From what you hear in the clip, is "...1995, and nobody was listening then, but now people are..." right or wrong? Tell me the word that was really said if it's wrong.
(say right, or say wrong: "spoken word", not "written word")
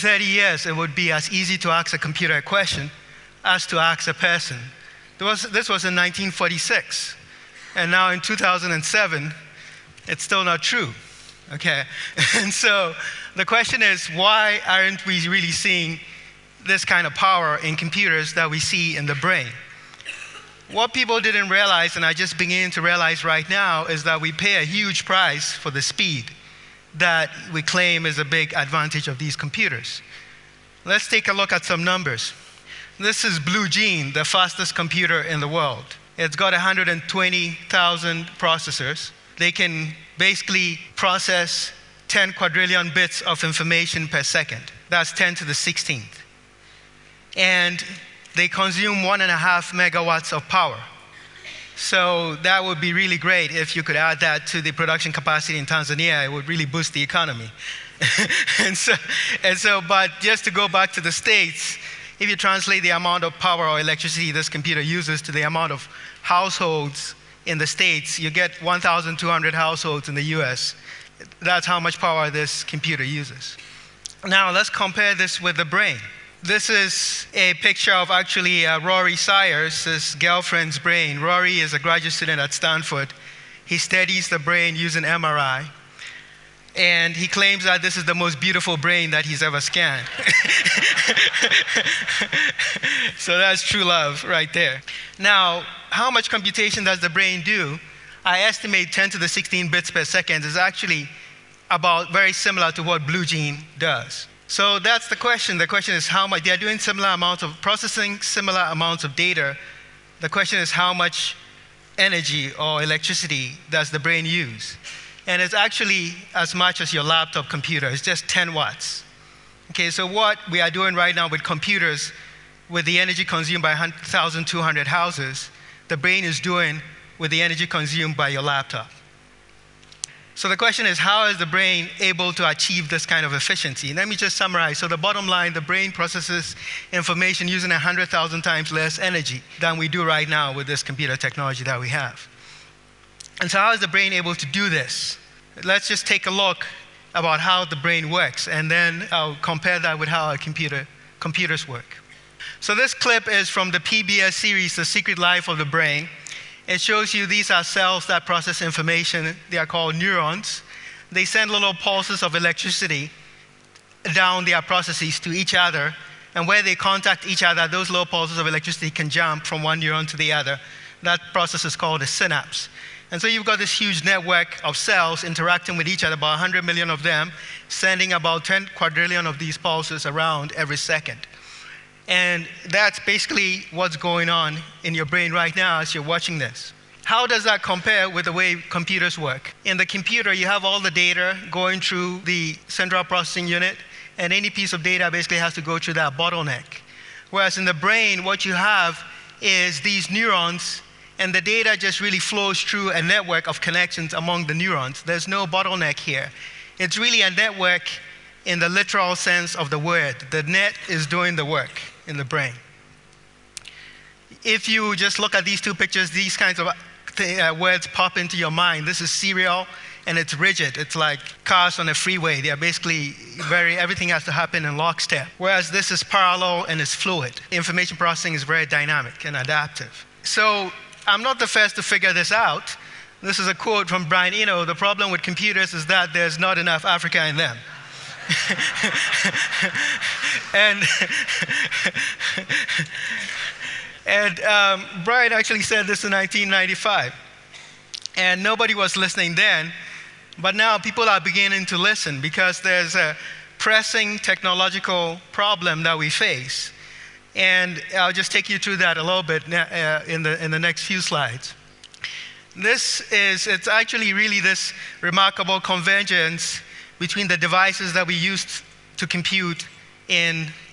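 right.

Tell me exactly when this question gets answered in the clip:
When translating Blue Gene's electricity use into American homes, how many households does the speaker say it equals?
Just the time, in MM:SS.
01:08.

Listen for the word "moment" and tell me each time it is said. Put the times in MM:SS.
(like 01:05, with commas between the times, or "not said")
not said.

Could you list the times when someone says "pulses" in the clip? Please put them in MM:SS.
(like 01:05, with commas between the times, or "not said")
02:41, 02:48, 02:59.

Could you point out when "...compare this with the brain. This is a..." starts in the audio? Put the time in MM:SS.
01:14.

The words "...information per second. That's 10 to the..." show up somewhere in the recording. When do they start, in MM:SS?
00:43.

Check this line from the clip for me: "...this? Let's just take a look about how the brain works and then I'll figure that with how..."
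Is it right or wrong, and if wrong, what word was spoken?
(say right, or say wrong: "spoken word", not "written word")
wrong: "compare", not "figure".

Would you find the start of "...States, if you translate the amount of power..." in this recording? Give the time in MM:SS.
01:01.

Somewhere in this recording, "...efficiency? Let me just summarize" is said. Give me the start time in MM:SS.
02:13.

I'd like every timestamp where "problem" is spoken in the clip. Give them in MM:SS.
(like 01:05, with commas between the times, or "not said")
03:54, 04:15.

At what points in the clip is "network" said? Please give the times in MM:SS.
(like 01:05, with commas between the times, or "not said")
02:54, 03:23, 03:27.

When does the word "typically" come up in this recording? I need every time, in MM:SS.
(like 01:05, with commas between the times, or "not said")
not said.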